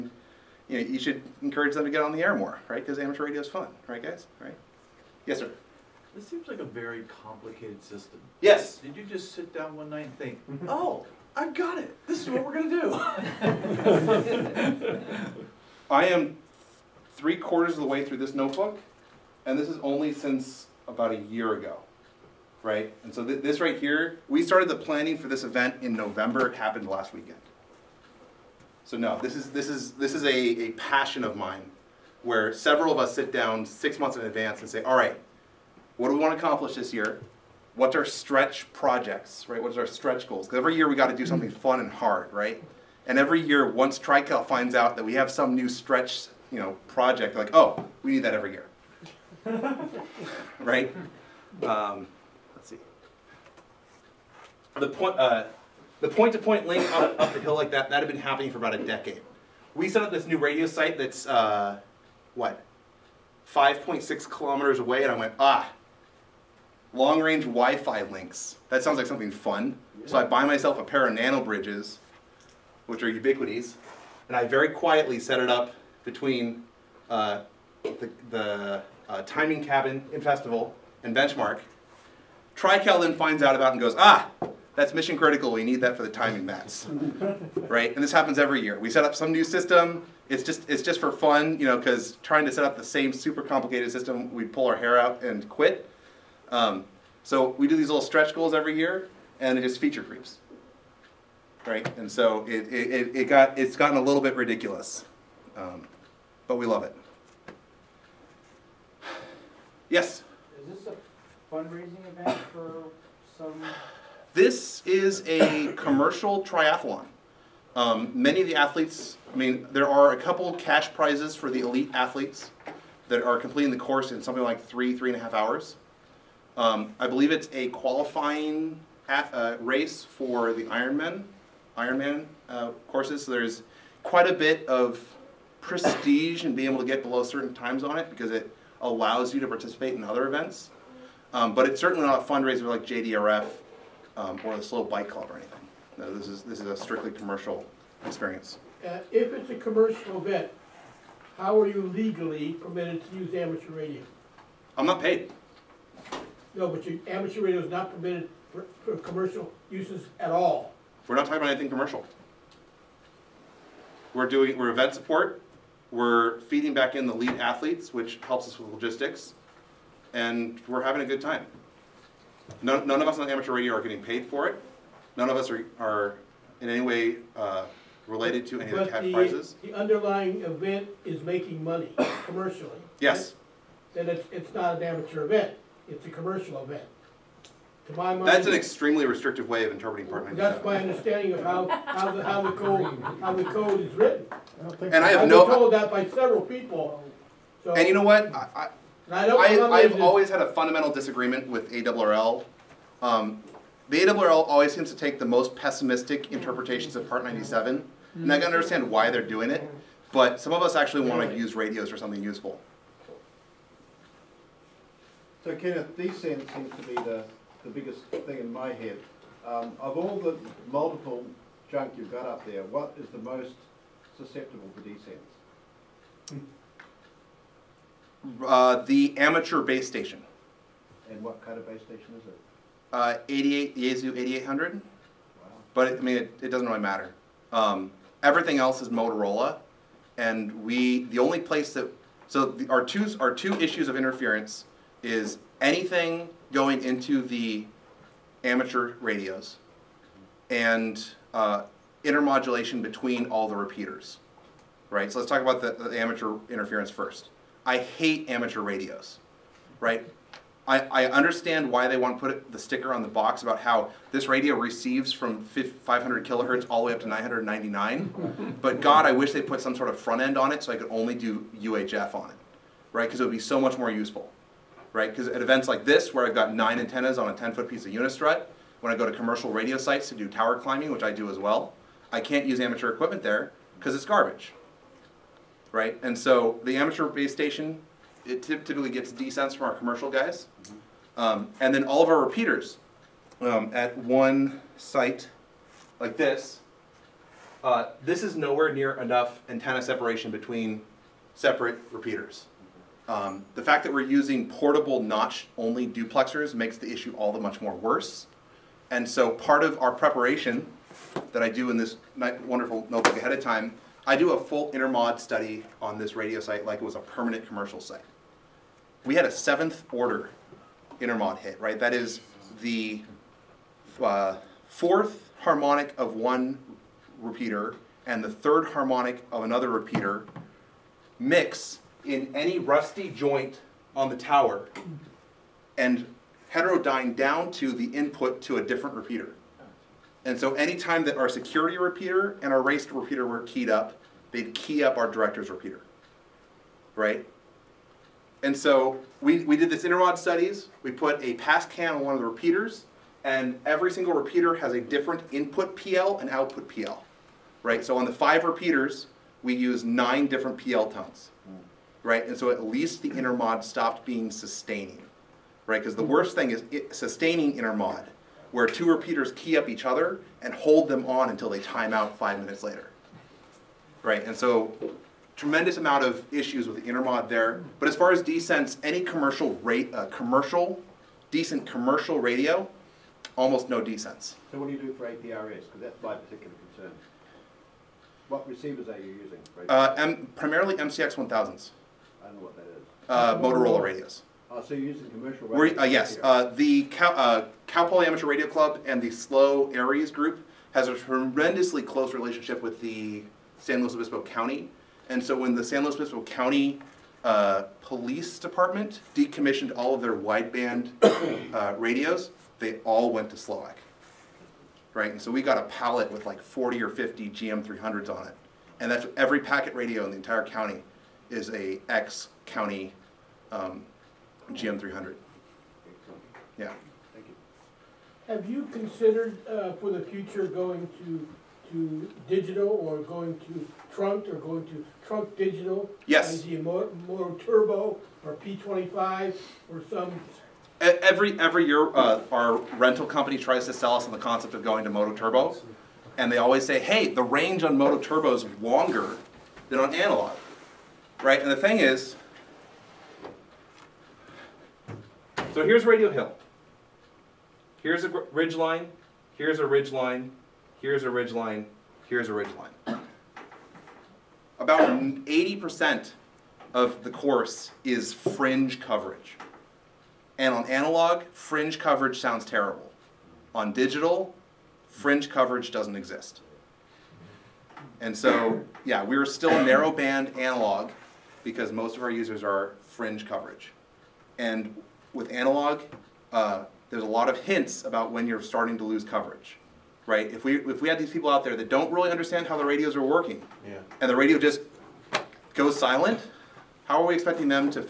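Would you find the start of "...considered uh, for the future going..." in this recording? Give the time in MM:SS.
07:08.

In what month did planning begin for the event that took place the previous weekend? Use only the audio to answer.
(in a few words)
November.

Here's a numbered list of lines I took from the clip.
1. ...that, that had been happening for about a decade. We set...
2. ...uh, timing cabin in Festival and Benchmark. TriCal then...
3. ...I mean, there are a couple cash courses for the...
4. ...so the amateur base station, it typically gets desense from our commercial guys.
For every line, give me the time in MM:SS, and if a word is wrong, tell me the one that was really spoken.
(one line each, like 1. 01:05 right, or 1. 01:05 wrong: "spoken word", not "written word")
1. 00:57 right
2. 01:19 right
3. 01:59 wrong: "prizes", not "courses"
4. 04:46 right.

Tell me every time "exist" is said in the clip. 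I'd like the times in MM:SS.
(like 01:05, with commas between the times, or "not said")
07:55.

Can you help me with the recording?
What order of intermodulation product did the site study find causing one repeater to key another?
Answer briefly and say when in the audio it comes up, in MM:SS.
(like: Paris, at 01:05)
Seventh order, at 05:19.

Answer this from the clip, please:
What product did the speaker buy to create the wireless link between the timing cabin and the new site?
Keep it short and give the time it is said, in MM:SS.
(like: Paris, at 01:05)
NanoBridges, at 01:11.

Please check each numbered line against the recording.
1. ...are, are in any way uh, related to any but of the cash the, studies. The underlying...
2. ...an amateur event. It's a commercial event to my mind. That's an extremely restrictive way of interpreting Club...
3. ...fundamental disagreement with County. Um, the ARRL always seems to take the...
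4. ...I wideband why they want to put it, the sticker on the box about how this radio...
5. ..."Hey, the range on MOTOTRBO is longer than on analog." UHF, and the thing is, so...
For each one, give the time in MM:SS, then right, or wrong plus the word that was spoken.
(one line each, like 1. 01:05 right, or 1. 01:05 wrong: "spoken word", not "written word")
1. 02:55 wrong: "prizes", not "studies"
2. 03:04 wrong: "Part", not "Club"
3. 03:20 wrong: "ARRL", not "County"
4. 04:20 wrong: "understand", not "wideband"
5. 07:26 wrong: "Right", not "UHF".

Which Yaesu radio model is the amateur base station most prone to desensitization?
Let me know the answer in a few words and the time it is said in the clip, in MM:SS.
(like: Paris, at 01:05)
8800, at 03:54.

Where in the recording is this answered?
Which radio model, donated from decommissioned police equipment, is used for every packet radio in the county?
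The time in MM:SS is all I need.
06:57.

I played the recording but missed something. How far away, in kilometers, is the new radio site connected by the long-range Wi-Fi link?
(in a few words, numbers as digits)
5.6 kilometers.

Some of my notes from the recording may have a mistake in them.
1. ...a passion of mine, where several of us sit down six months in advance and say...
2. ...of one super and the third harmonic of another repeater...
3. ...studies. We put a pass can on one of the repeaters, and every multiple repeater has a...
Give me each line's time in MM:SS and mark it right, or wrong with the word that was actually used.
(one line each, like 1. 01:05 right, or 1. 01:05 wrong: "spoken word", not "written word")
1. 00:30 right
2. 05:25 wrong: "repeater", not "super"
3. 05:50 wrong: "single", not "multiple".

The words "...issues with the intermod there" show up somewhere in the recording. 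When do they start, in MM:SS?
06:16.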